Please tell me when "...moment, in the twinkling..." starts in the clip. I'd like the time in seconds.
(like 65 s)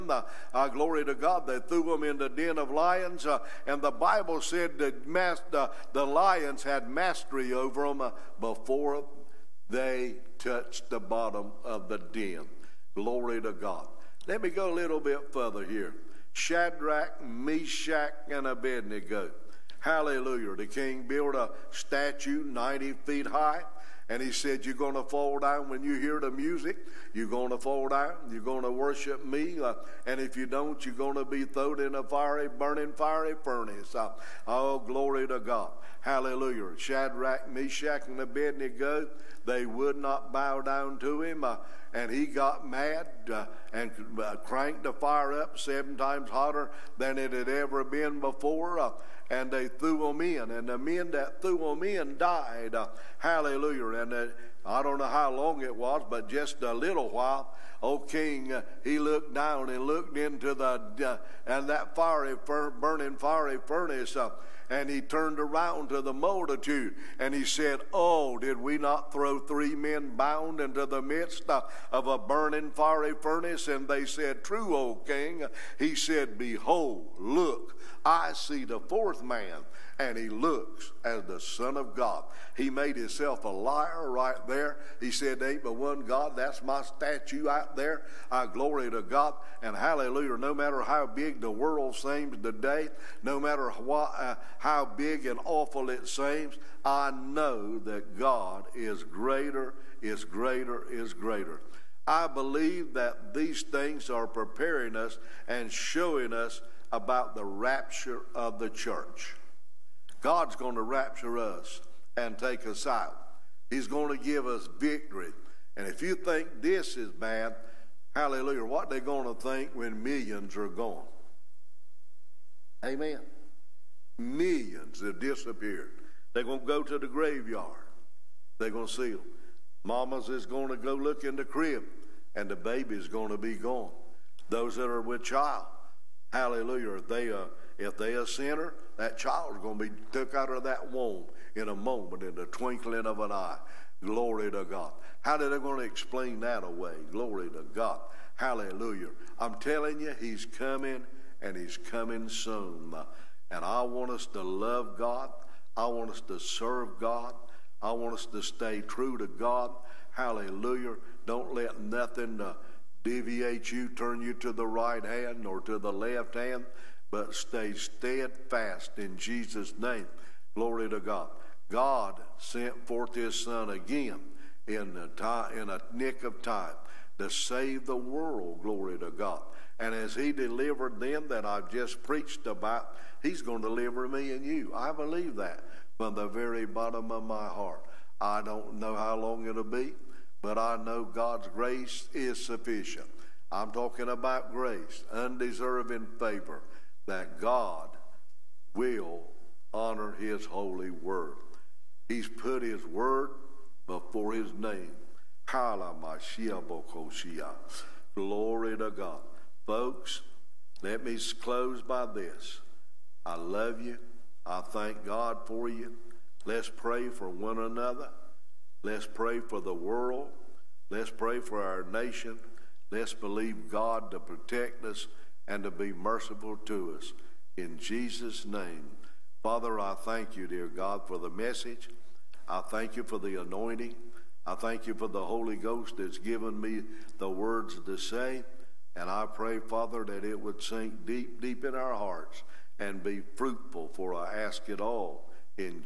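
141 s.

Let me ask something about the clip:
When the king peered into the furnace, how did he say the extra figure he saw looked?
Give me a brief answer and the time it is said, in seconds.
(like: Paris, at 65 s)
As the Son of God, at 81 s.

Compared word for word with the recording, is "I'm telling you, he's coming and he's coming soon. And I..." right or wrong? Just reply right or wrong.
right.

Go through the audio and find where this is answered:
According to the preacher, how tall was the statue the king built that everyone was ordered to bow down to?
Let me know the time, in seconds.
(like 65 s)
22 s.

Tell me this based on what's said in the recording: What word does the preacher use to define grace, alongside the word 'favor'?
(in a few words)
Undeserving.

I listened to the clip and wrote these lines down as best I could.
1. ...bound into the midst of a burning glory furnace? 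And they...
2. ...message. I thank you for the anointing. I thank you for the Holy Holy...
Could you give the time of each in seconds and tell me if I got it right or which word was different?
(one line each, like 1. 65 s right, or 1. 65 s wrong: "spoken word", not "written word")
1. 70 s wrong: "fiery", not "glory"
2. 231 s wrong: "Ghost", not "Holy".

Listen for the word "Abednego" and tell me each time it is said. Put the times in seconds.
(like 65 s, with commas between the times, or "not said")
18 s, 38 s.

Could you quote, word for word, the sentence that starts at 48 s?
Uh, and they threw him in, and the men that threw him in died.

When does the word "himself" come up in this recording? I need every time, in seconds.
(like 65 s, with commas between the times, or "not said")
82 s.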